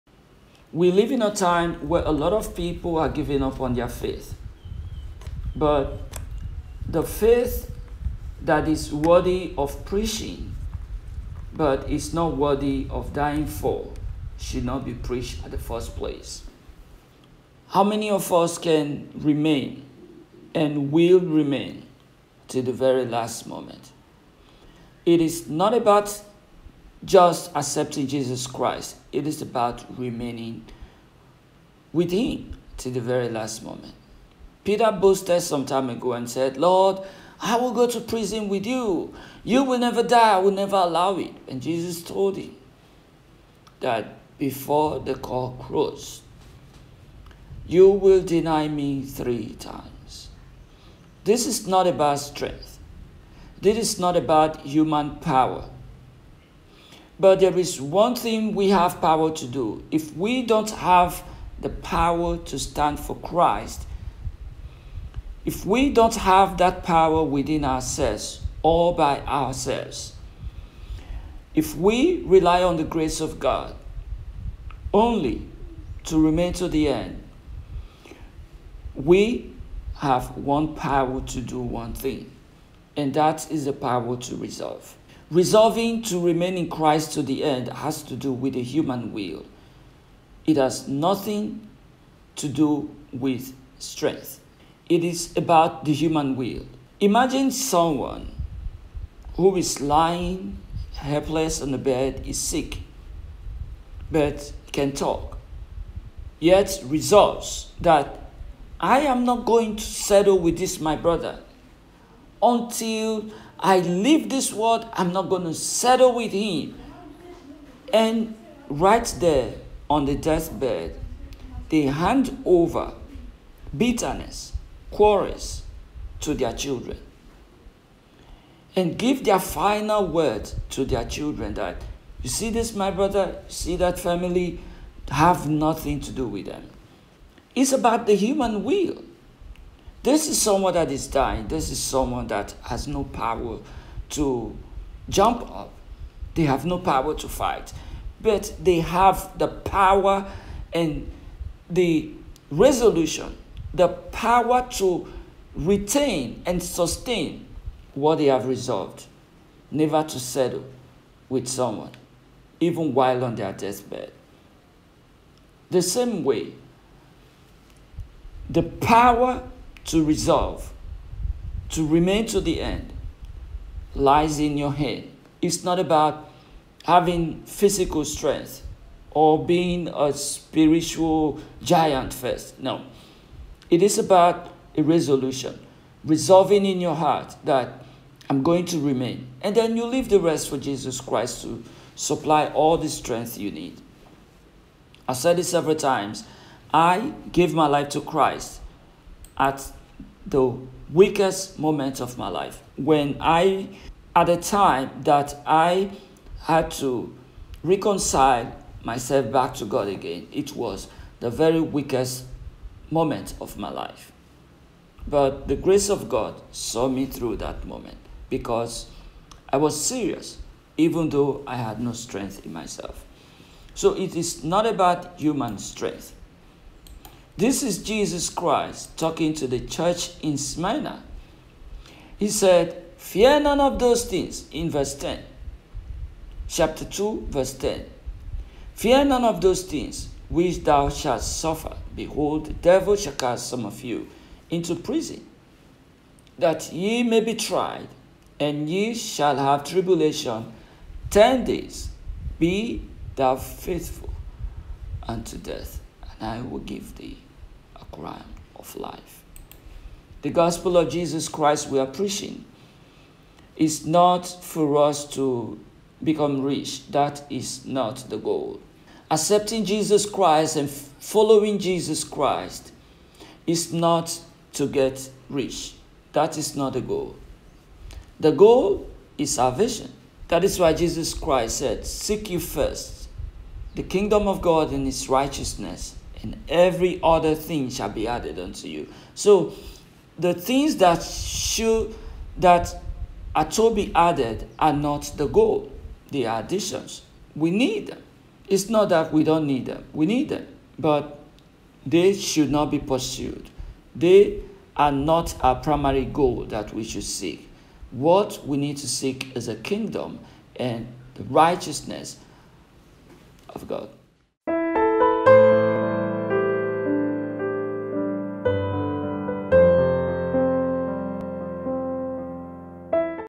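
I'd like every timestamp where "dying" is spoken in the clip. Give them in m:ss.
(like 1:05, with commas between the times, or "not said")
0:13, 2:21.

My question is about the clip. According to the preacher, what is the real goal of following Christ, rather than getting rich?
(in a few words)
salvation.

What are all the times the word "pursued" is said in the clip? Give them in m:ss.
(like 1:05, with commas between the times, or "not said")
5:02.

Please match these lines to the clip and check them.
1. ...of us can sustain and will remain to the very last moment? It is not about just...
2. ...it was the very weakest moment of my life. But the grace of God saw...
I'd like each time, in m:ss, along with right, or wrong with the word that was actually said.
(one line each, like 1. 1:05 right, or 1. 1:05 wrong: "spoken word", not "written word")
1. 0:18 wrong: "remain", not "sustain"
2. 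3:30 right.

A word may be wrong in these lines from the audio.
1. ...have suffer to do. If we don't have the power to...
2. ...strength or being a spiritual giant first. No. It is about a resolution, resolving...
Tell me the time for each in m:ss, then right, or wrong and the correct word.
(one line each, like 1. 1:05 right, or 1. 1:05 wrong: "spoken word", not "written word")
1. 0:58 wrong: "power", not "suffer"
2. 2:58 right.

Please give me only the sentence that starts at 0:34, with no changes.
Peter boasted some time ago and said, Lord, I will go to prison with you.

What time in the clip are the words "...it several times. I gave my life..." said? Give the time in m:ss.
3:15.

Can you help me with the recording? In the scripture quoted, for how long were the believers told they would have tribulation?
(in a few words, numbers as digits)
10 days.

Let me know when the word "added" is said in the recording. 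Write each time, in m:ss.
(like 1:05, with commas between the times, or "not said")
4:48, 4:53.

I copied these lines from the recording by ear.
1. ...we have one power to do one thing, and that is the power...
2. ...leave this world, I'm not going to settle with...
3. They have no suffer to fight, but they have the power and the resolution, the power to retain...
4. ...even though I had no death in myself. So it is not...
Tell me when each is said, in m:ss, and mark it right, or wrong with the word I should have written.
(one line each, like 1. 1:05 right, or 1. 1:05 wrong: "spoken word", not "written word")
1. 1:18 right
2. 1:53 right
3. 2:26 wrong: "power", not "suffer"
4. 3:40 wrong: "strength", not "death".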